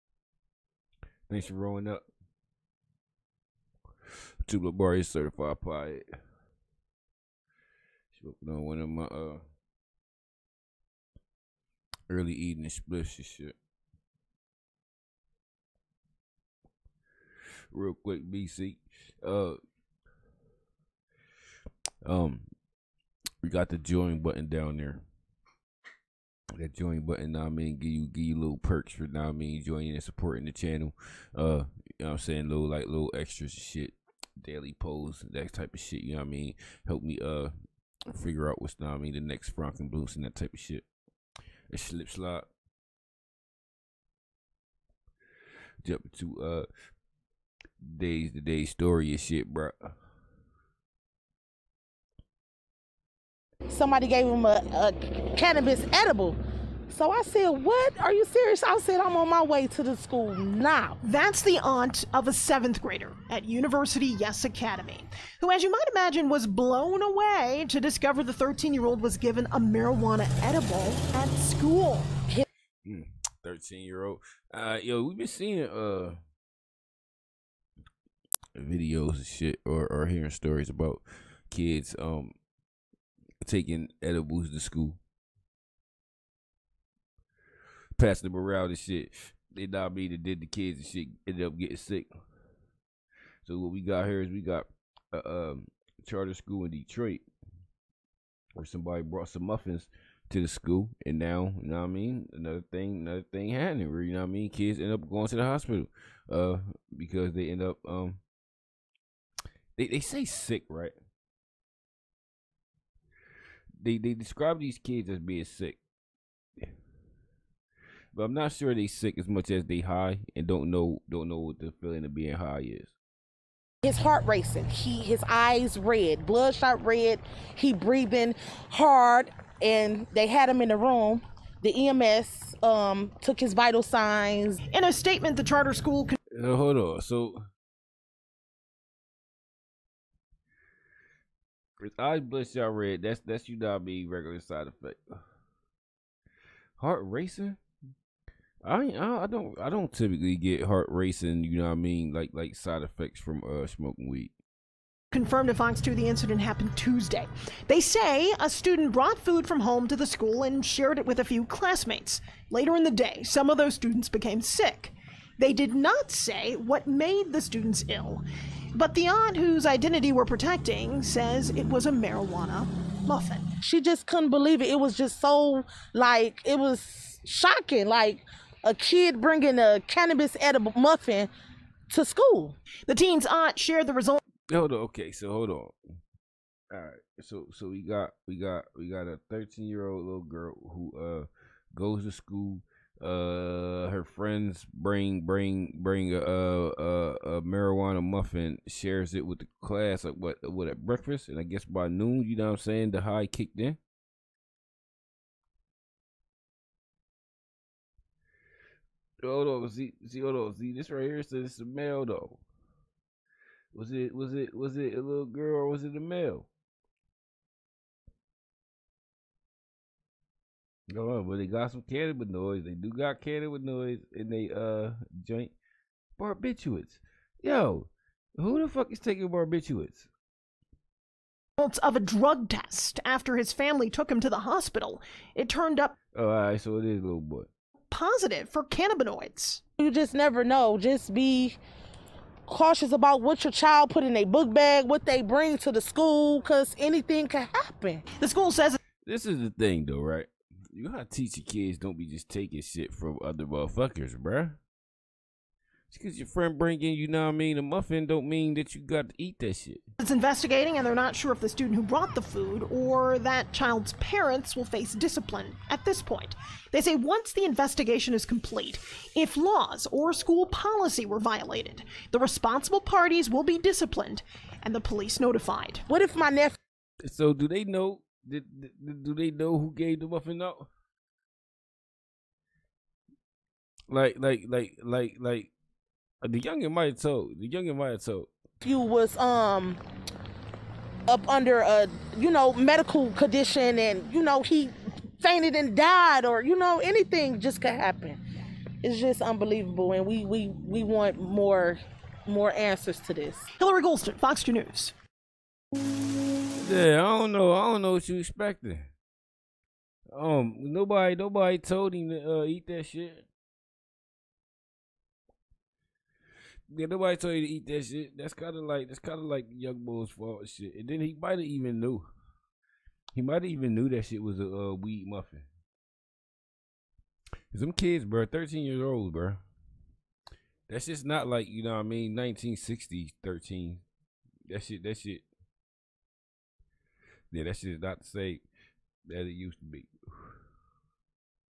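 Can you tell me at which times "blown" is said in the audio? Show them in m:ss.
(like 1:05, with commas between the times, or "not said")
1:06.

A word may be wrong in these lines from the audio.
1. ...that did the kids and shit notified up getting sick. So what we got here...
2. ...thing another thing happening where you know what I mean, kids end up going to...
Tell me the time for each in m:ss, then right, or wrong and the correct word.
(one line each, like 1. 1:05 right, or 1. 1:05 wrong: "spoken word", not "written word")
1. 1:29 wrong: "ended", not "notified"
2. 1:42 right.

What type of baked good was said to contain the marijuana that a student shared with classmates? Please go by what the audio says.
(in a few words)
Muffins.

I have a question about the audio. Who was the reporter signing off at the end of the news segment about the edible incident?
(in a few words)
Hilary Golston.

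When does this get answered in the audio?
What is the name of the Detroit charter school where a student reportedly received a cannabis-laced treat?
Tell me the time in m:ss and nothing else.
1:03.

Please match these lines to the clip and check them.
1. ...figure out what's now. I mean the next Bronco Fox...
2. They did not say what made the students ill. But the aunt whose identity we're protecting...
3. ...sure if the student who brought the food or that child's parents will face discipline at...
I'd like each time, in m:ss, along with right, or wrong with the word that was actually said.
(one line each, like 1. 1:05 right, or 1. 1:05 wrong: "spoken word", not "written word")
1. 0:38 wrong: "Blues", not "Fox"
2. 2:45 right
3. 4:21 right.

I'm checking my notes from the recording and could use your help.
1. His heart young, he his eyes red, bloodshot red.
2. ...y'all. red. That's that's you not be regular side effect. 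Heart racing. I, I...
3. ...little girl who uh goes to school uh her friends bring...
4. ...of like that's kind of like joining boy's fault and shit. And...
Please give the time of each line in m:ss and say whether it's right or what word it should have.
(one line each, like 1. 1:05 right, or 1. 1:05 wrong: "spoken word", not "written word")
1. 2:03 wrong: "racing", not "young"
2. 2:22 right
3. 3:10 right
4. 5:18 wrong: "young", not "joining".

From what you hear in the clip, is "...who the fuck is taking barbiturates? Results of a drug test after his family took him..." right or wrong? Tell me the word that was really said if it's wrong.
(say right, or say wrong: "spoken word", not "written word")
right.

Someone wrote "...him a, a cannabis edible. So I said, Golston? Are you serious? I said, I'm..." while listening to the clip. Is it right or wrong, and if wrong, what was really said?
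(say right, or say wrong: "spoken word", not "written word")
wrong: "What", not "Golston".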